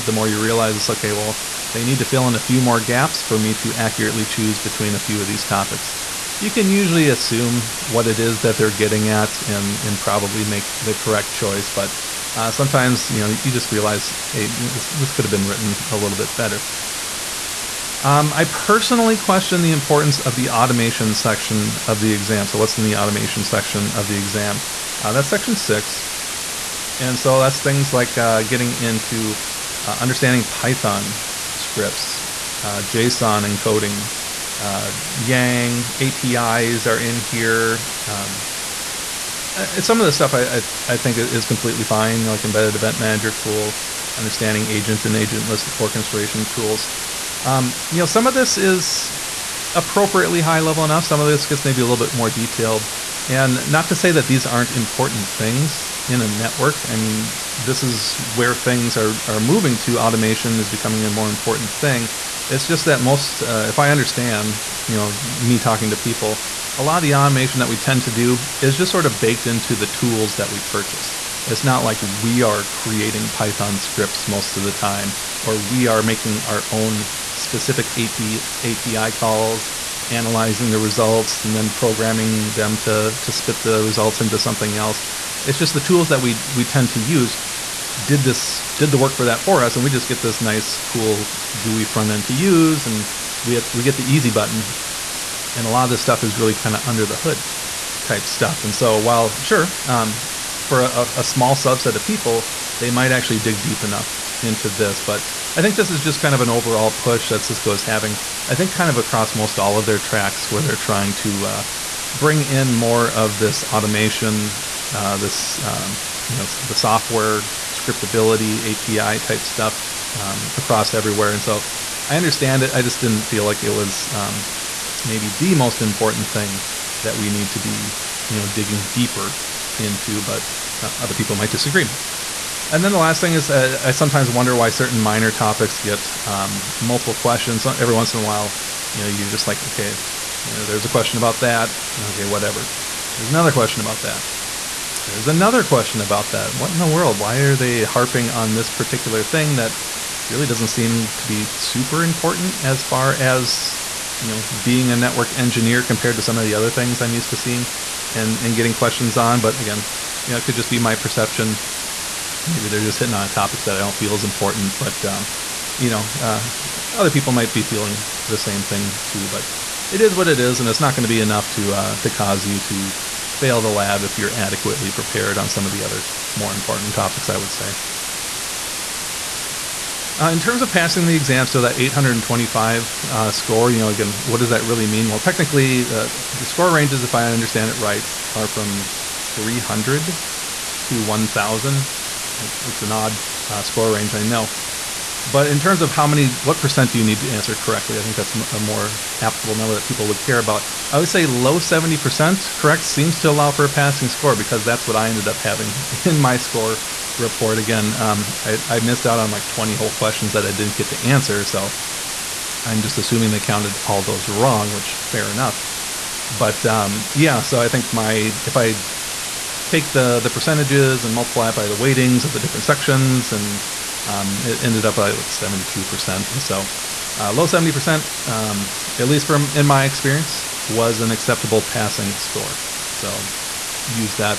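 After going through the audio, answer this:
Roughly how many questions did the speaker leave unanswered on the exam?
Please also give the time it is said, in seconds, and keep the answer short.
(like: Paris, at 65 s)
20, at 209 s.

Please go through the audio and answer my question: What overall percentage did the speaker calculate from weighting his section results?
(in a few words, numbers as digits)
72%.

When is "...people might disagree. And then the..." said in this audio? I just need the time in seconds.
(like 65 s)
131 s.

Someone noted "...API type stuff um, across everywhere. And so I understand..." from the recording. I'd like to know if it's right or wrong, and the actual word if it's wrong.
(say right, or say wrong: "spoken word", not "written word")
right.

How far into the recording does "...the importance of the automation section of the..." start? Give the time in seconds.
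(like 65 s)
19 s.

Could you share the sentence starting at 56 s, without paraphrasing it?
I mean, this is where things are, are moving to.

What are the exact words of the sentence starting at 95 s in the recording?
And a lot of this stuff is really kind of under the hood type stuff.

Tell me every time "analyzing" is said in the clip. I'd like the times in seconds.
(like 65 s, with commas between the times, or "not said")
80 s.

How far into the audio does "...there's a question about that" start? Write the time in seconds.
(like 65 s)
140 s.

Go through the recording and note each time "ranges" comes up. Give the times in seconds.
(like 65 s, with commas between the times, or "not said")
186 s, 193 s.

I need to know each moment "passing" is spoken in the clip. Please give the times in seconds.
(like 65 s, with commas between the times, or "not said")
180 s, 203 s, 231 s.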